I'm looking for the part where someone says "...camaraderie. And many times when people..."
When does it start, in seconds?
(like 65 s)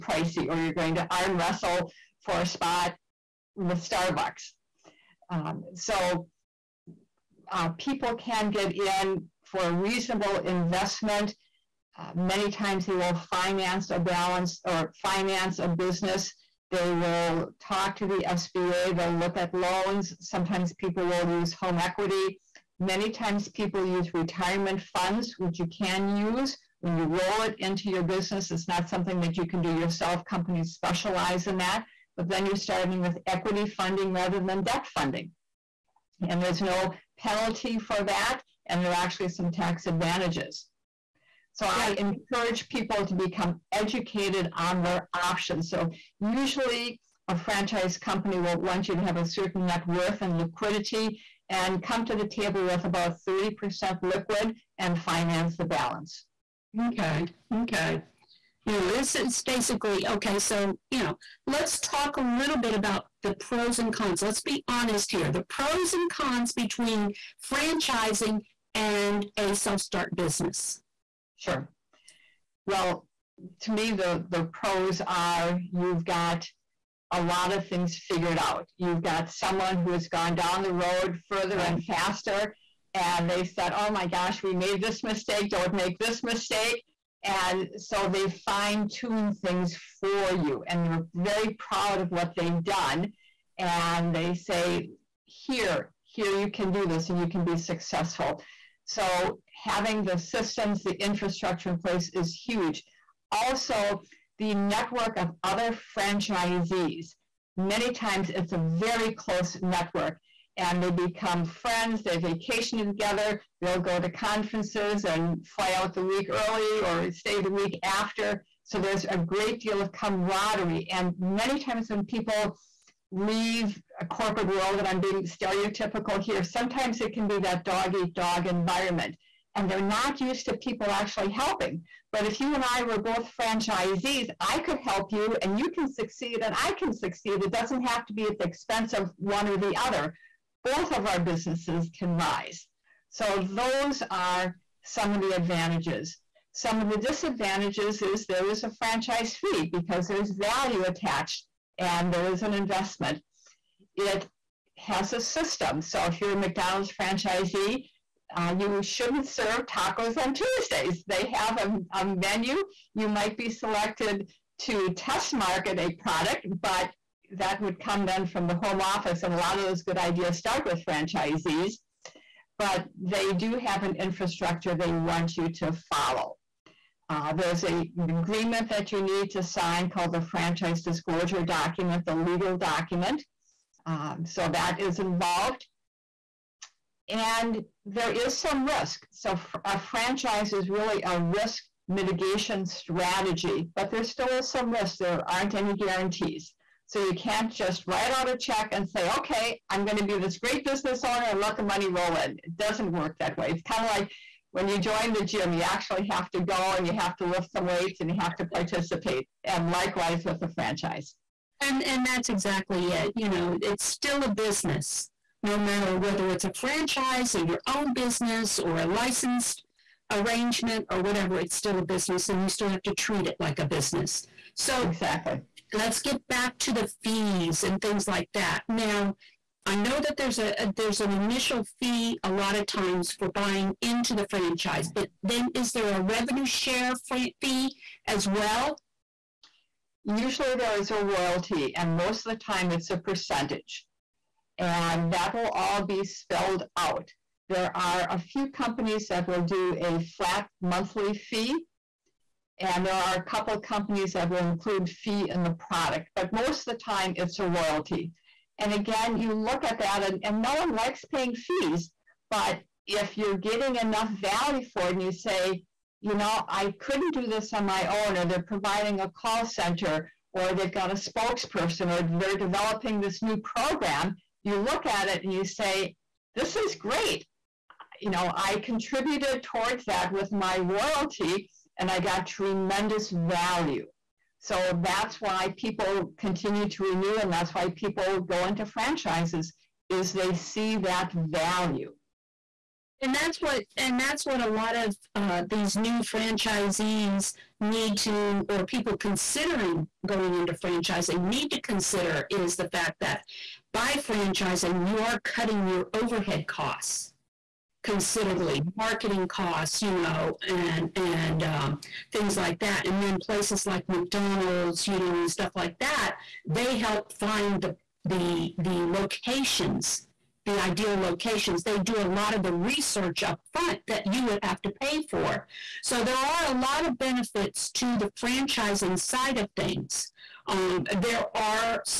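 119 s.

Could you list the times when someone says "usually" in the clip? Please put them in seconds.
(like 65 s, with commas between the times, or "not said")
46 s, 240 s.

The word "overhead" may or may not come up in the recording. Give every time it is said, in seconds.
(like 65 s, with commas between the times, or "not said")
305 s.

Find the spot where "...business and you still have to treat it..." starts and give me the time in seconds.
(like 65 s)
221 s.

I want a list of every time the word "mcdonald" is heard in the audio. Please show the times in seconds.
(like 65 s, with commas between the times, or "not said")
156 s, 313 s.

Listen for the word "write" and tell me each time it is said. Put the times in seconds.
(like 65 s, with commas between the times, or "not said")
197 s.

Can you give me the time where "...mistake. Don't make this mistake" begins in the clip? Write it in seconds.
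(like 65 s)
85 s.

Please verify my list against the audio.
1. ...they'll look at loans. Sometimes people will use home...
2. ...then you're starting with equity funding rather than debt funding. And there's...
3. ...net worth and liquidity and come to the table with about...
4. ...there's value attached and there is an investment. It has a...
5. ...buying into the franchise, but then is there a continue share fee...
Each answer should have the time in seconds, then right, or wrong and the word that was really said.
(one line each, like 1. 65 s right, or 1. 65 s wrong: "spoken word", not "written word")
1. 18 s right
2. 32 s right
3. 49 s right
4. 150 s right
5. 233 s wrong: "revenue", not "continue".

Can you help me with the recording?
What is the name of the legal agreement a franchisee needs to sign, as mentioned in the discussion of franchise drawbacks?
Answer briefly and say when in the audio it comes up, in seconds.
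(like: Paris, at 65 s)
franchise disclosure document, at 180 s.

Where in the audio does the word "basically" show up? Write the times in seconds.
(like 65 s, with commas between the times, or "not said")
59 s.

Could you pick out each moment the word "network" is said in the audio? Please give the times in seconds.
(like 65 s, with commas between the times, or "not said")
104 s, 109 s.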